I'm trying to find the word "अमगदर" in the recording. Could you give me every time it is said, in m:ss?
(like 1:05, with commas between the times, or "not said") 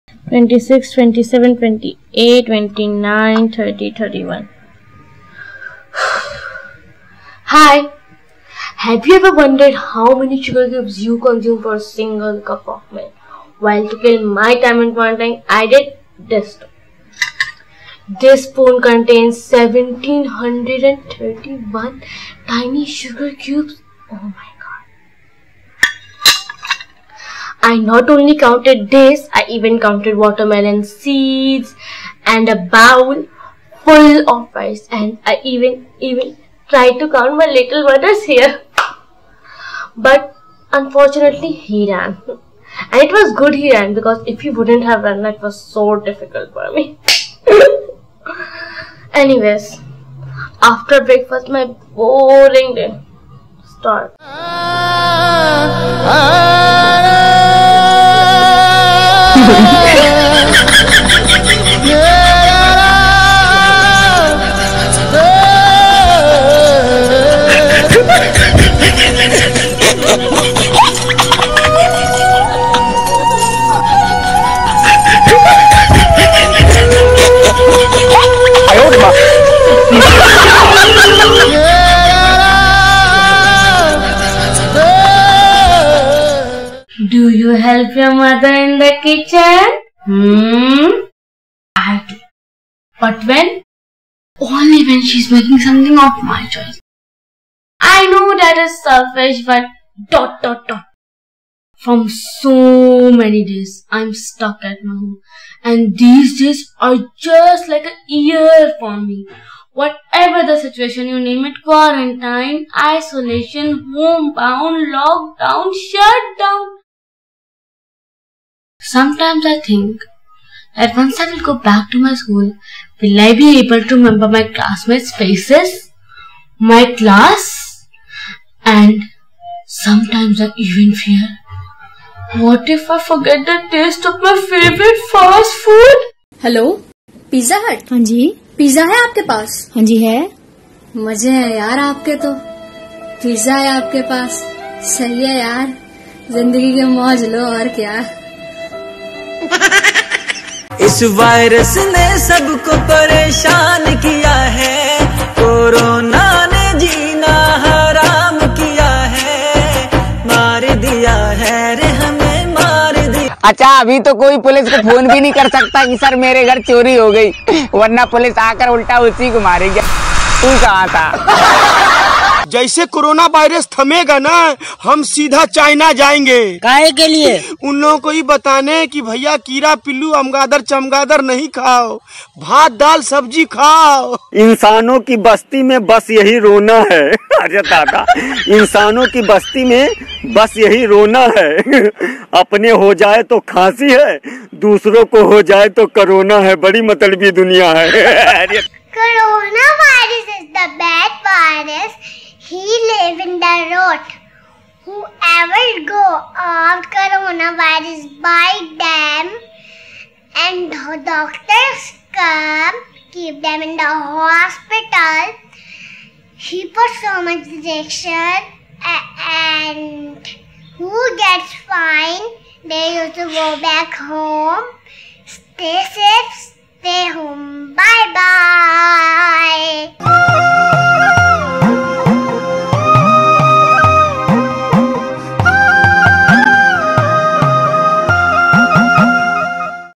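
3:00.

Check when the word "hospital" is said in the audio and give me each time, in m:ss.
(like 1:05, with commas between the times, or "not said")
3:34.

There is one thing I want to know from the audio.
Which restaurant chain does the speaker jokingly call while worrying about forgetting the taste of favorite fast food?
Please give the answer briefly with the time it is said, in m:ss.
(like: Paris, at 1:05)
Pizza Hut, at 2:17.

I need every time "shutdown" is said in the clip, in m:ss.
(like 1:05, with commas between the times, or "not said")
1:55.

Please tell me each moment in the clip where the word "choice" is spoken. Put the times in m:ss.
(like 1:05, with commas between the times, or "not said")
1:36.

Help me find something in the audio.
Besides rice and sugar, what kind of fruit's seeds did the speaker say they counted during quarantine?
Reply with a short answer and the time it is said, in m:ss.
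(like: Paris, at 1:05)
Watermelon, at 0:30.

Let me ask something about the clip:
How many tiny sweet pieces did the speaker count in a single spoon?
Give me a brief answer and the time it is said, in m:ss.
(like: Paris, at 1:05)
1731, at 0:19.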